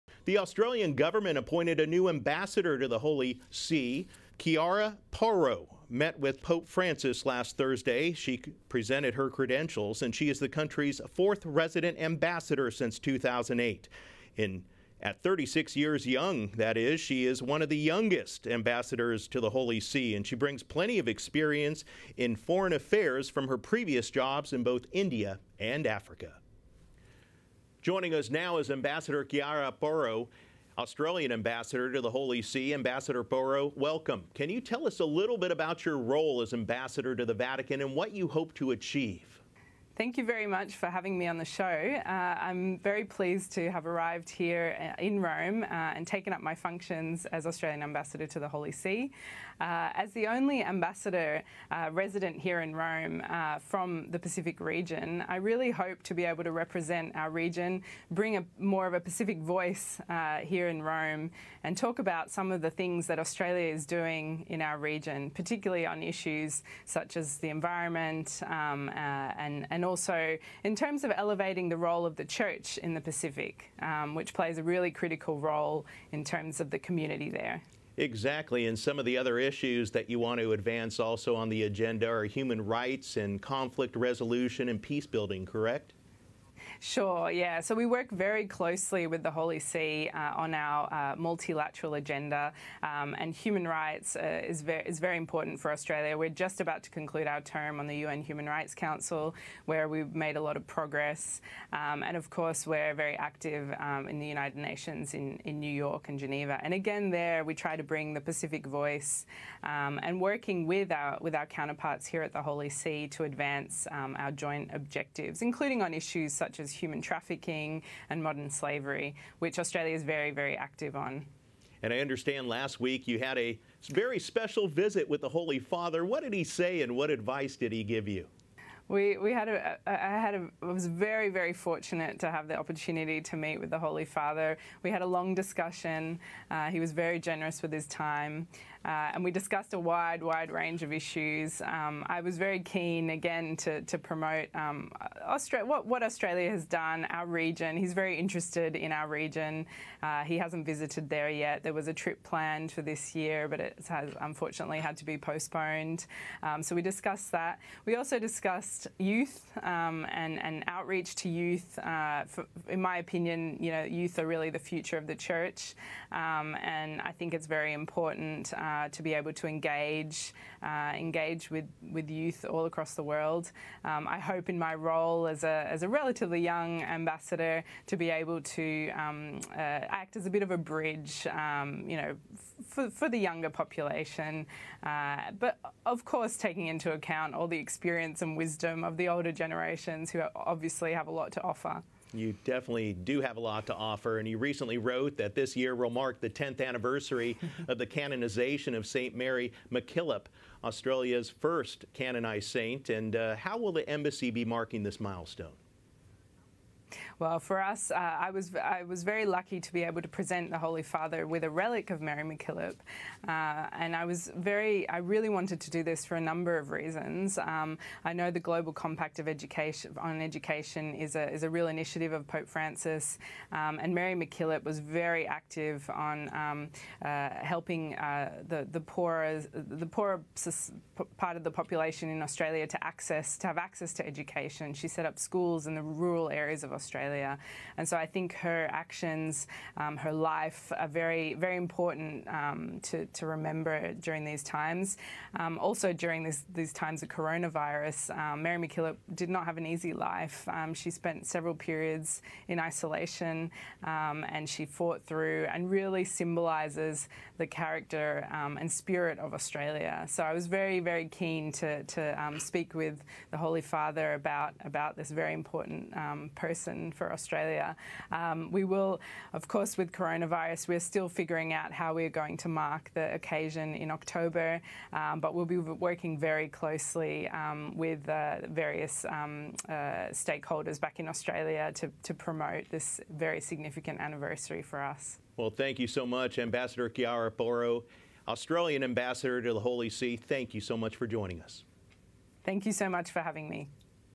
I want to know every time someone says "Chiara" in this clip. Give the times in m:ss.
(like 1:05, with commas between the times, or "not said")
0:04, 0:29, 4:46.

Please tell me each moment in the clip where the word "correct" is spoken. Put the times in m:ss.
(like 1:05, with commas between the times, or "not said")
1:25.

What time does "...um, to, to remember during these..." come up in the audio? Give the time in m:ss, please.
4:02.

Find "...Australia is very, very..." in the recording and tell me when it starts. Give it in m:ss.
1:59.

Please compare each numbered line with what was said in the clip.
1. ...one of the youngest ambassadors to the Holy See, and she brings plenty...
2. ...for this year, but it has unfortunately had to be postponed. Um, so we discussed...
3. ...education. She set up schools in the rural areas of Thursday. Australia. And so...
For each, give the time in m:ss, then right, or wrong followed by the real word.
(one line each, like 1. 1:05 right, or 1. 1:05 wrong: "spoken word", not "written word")
1. 0:17 right
2. 2:32 right
3. 3:54 wrong: "Australia", not "Thursday".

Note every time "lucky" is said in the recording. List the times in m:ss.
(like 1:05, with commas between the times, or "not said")
3:29.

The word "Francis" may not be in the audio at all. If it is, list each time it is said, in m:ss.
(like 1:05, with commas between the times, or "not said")
0:06, 3:42.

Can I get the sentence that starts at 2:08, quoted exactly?
We, we had a, I had a, I was very, very fortunate to have the opportunity to meet with the Holy Father.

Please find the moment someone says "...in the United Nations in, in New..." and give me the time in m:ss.
1:44.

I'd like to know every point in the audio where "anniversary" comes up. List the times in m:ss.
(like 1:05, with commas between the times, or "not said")
3:16, 4:43.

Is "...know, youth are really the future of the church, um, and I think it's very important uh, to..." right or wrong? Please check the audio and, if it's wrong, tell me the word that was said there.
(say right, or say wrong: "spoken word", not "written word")
right.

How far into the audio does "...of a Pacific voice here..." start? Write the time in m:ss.
0:58.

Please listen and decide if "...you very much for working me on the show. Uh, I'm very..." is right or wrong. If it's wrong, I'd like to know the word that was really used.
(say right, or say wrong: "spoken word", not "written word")
wrong: "having", not "working".